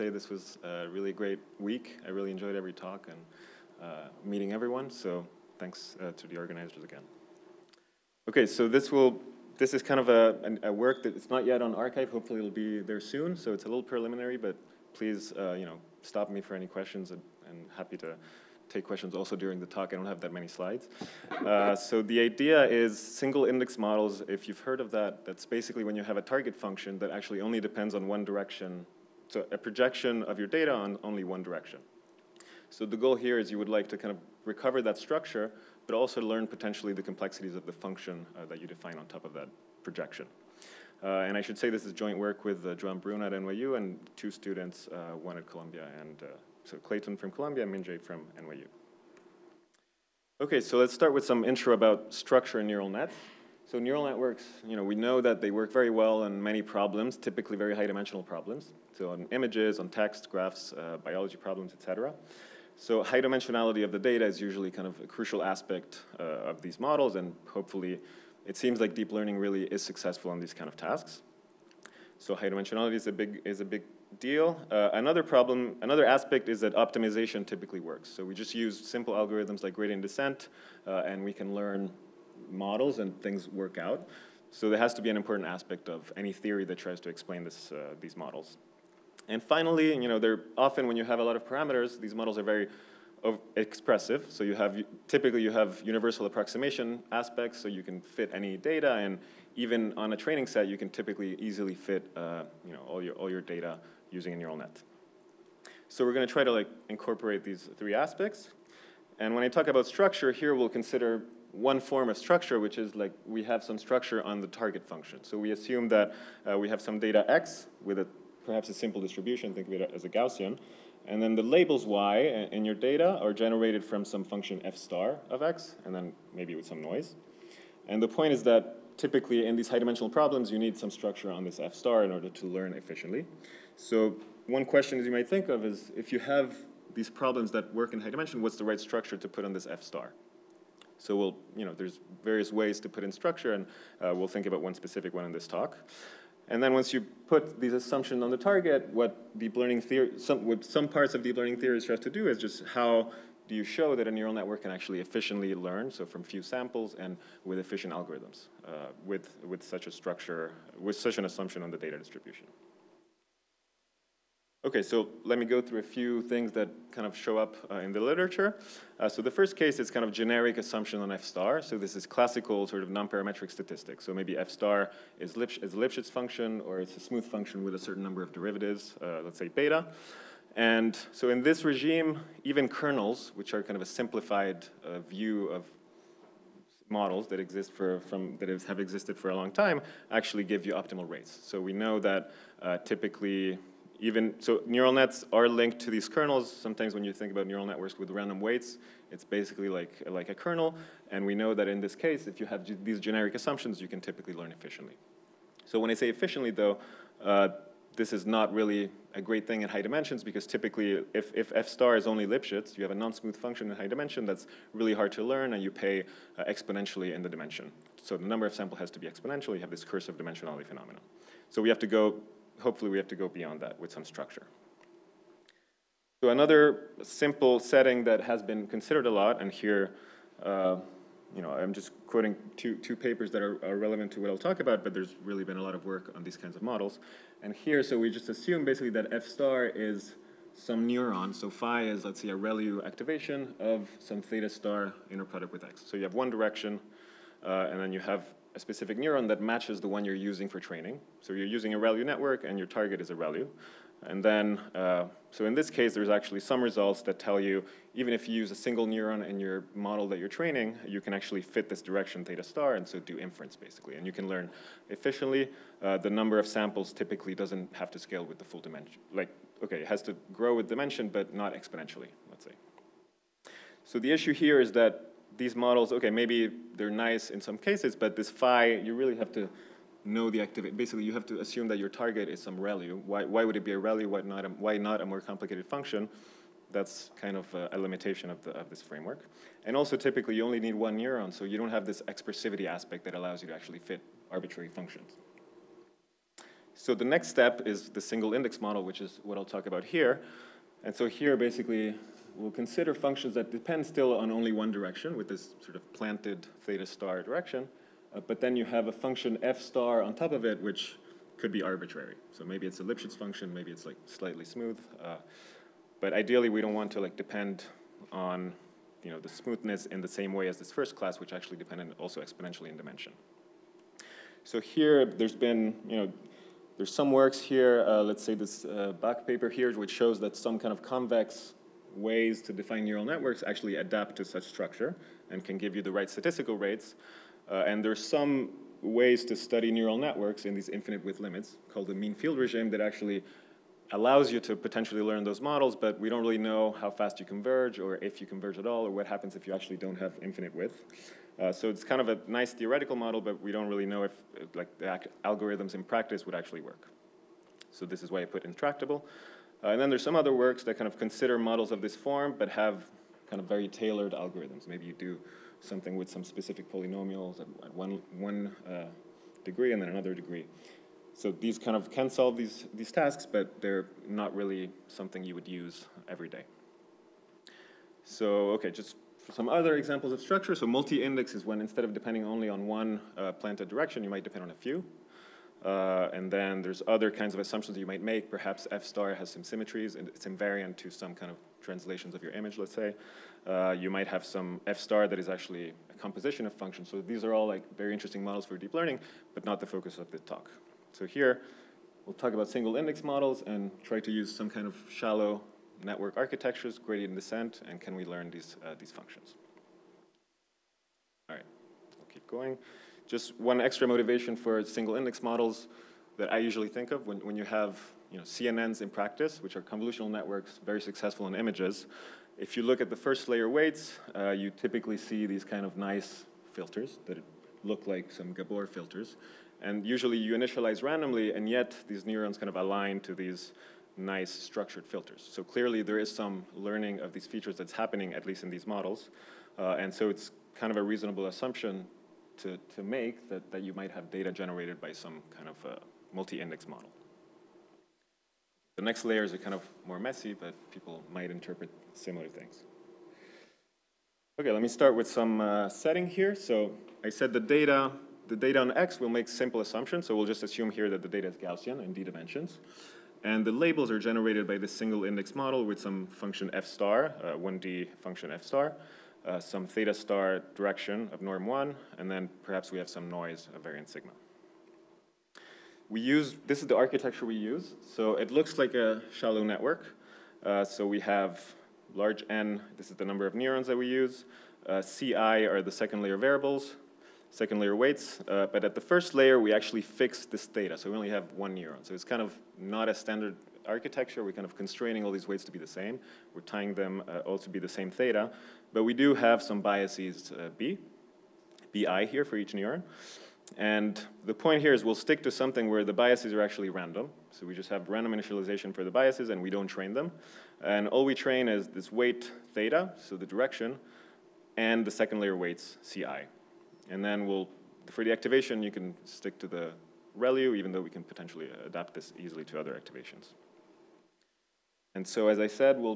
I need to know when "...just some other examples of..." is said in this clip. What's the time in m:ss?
6:18.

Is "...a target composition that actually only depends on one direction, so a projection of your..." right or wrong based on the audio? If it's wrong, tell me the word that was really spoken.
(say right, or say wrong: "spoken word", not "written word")
wrong: "function", not "composition".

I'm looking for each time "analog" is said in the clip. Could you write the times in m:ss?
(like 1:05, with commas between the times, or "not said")
not said.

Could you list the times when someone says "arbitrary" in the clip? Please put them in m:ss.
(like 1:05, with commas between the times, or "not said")
4:54, 5:11.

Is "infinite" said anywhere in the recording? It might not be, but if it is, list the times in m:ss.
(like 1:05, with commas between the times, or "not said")
5:40, 5:50.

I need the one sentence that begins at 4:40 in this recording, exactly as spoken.
Basically, you have to assume that your target is some ReLU.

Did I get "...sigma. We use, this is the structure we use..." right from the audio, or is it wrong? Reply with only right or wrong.
wrong.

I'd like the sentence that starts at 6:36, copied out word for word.
So these are all like very interesting models for deep learning, but not the focus of the talk.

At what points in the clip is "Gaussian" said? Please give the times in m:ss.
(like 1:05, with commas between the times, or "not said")
2:00, 7:41.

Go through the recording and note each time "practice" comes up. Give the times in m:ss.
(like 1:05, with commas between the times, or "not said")
5:55, 6:58.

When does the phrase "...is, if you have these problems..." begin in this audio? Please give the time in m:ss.
2:15.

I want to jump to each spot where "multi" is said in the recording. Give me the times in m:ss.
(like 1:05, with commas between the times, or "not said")
6:20, 7:26.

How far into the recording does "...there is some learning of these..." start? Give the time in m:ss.
7:15.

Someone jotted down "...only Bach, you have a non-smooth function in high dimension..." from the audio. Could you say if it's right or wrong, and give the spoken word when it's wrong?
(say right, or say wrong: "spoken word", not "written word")
wrong: "Lipschitz", not "Bach".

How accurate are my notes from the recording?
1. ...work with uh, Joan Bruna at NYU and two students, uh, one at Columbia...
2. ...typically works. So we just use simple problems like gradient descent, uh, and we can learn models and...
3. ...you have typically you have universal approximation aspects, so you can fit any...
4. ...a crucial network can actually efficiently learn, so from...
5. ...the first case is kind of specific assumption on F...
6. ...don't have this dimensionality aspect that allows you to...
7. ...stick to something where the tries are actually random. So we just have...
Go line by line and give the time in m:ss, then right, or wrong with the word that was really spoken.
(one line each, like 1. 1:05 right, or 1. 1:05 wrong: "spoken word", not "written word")
1. 0:42 right
2. 1:17 wrong: "algorithms", not "problems"
3. 1:34 right
4. 2:34 wrong: "neural", not "crucial"
5. 2:49 wrong: "generic", not "specific"
6. 4:51 wrong: "expressivity", not "dimensionality"
7. 8:25 wrong: "biases", not "tries".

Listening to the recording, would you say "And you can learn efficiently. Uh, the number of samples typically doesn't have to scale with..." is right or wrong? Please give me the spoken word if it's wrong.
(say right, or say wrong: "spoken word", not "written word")
right.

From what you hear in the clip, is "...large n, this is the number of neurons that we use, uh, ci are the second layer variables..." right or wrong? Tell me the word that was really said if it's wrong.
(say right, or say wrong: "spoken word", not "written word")
right.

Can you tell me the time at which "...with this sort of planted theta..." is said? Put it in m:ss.
5:05.